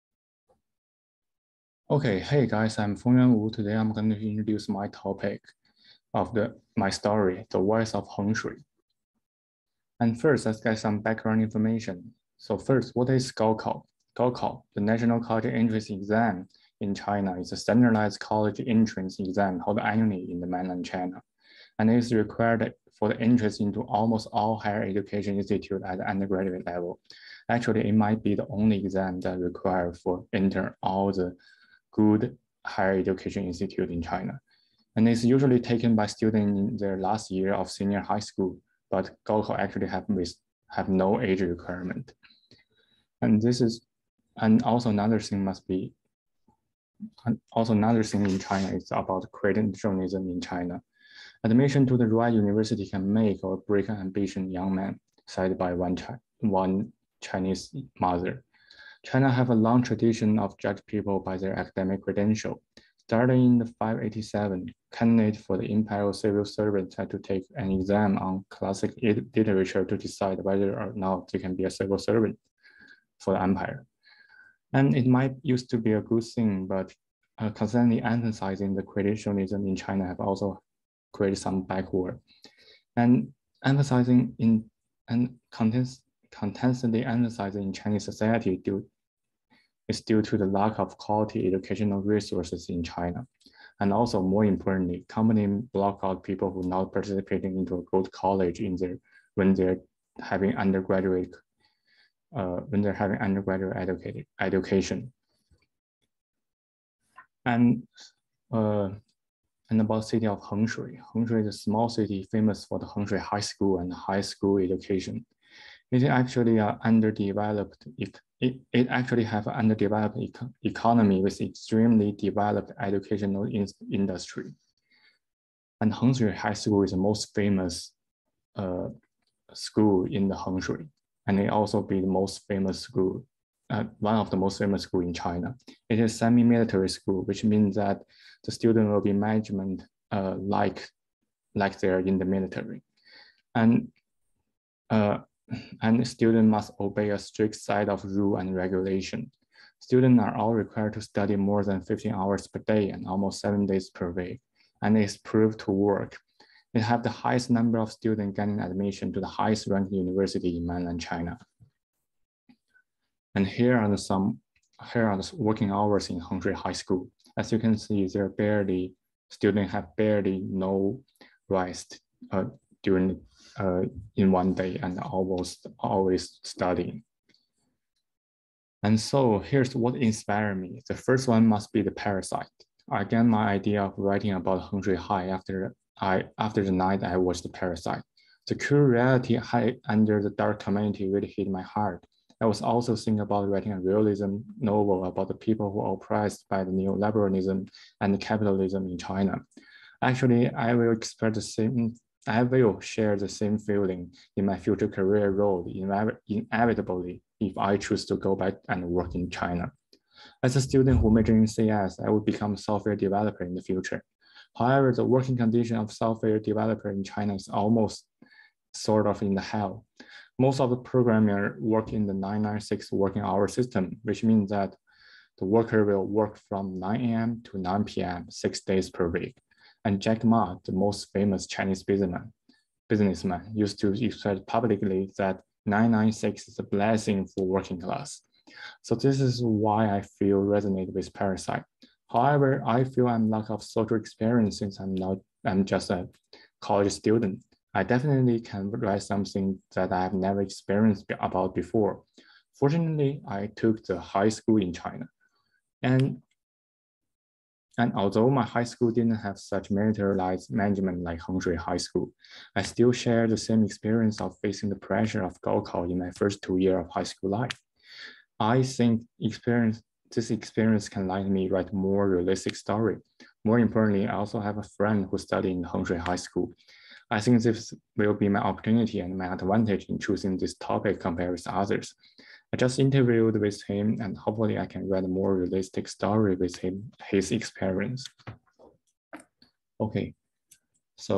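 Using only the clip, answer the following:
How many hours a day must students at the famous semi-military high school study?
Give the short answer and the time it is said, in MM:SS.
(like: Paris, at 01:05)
more than 15 hours, at 02:31.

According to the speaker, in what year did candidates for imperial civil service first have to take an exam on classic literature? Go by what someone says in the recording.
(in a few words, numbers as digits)
587.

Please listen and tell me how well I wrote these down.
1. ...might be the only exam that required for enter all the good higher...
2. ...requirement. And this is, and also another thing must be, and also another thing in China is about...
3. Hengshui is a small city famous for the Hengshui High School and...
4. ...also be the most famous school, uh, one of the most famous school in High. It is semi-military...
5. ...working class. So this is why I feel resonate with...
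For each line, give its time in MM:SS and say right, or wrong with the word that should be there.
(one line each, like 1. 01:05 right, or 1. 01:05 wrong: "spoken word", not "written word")
1. 00:27 right
2. 00:41 right
3. 01:51 right
4. 02:11 wrong: "China", not "High"
5. 03:57 right.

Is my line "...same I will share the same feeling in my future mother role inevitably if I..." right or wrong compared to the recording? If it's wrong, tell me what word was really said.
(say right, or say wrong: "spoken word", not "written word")
wrong: "career", not "mother".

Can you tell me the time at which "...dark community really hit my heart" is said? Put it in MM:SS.
03:10.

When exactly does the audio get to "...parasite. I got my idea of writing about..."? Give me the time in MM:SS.
03:01.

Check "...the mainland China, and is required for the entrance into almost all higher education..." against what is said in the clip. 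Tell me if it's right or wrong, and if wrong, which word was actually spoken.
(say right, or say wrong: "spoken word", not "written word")
right.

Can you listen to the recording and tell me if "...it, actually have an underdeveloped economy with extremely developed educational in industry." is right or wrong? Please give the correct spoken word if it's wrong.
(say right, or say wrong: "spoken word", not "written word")
right.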